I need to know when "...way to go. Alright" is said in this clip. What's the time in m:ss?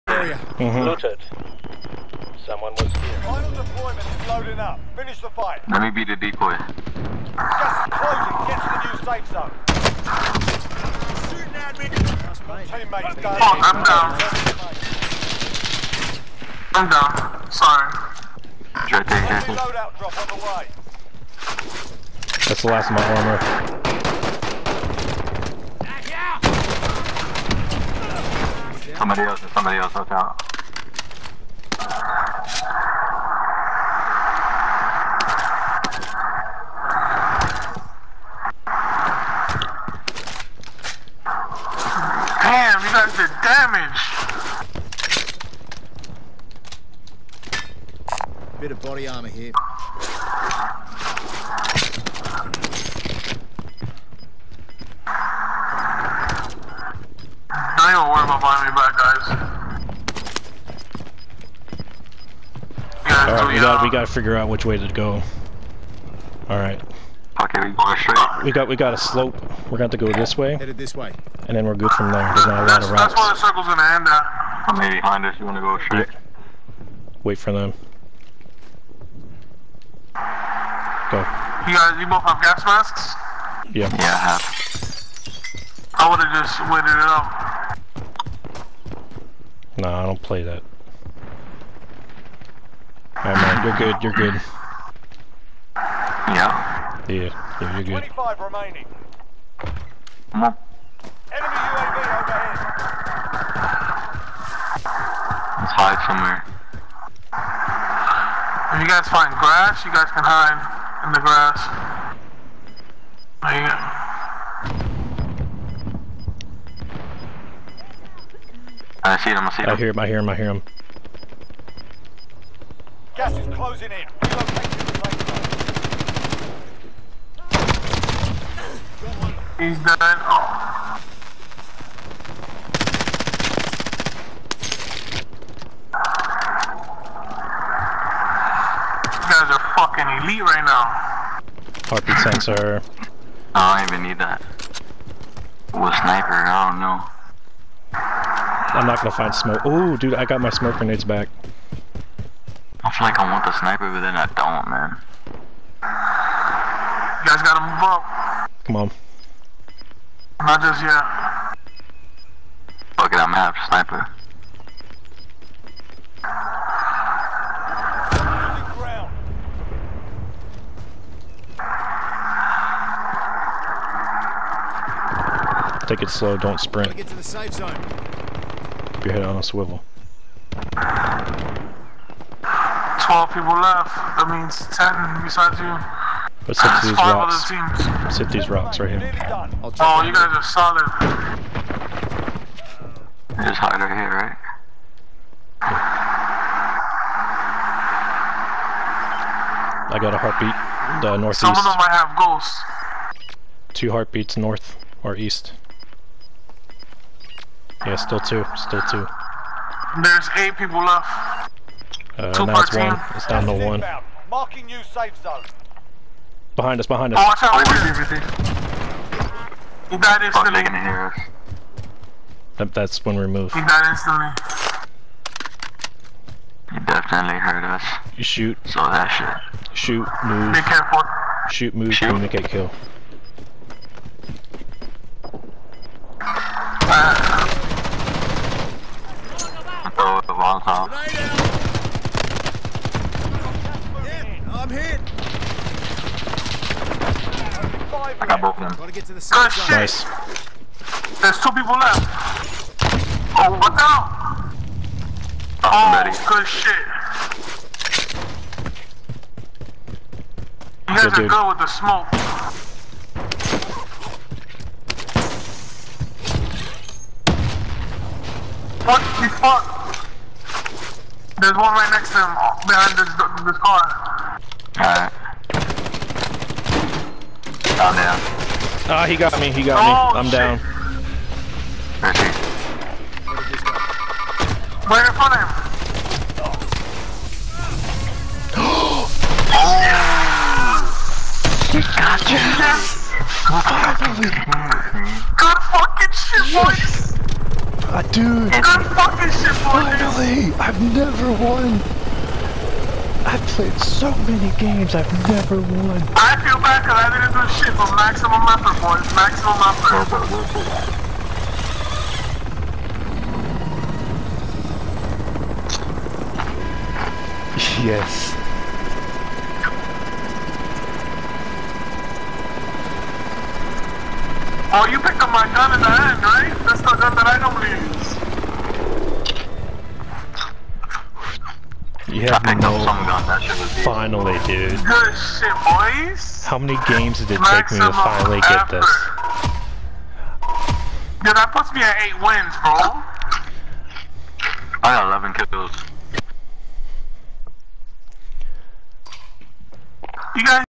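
1:04.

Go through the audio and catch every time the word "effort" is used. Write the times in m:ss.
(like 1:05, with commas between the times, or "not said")
5:08, 5:16, 5:38.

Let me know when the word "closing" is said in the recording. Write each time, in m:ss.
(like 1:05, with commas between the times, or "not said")
0:07, 2:03.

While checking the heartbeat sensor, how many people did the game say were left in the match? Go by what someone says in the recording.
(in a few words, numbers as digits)
8.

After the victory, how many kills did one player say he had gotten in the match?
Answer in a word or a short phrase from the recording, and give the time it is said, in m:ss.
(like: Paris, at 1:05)
11, at 5:45.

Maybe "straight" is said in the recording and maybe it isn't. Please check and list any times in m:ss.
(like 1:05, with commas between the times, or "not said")
1:07, 1:15.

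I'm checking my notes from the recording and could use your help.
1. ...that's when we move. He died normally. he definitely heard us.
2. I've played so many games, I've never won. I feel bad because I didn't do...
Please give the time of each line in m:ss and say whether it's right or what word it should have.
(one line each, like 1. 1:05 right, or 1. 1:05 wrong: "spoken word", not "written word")
1. 3:42 wrong: "instantly", not "normally"
2. 5:03 right.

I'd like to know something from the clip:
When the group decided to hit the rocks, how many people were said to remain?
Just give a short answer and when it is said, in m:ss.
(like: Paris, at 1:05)
12, at 3:00.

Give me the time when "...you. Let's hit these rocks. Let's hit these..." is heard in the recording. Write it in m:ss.
3:05.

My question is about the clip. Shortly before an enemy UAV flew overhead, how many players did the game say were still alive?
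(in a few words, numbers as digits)
25.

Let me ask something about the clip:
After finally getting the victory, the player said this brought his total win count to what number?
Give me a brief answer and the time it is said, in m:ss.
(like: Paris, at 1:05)
8, at 5:42.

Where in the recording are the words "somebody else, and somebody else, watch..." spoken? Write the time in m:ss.
0:29.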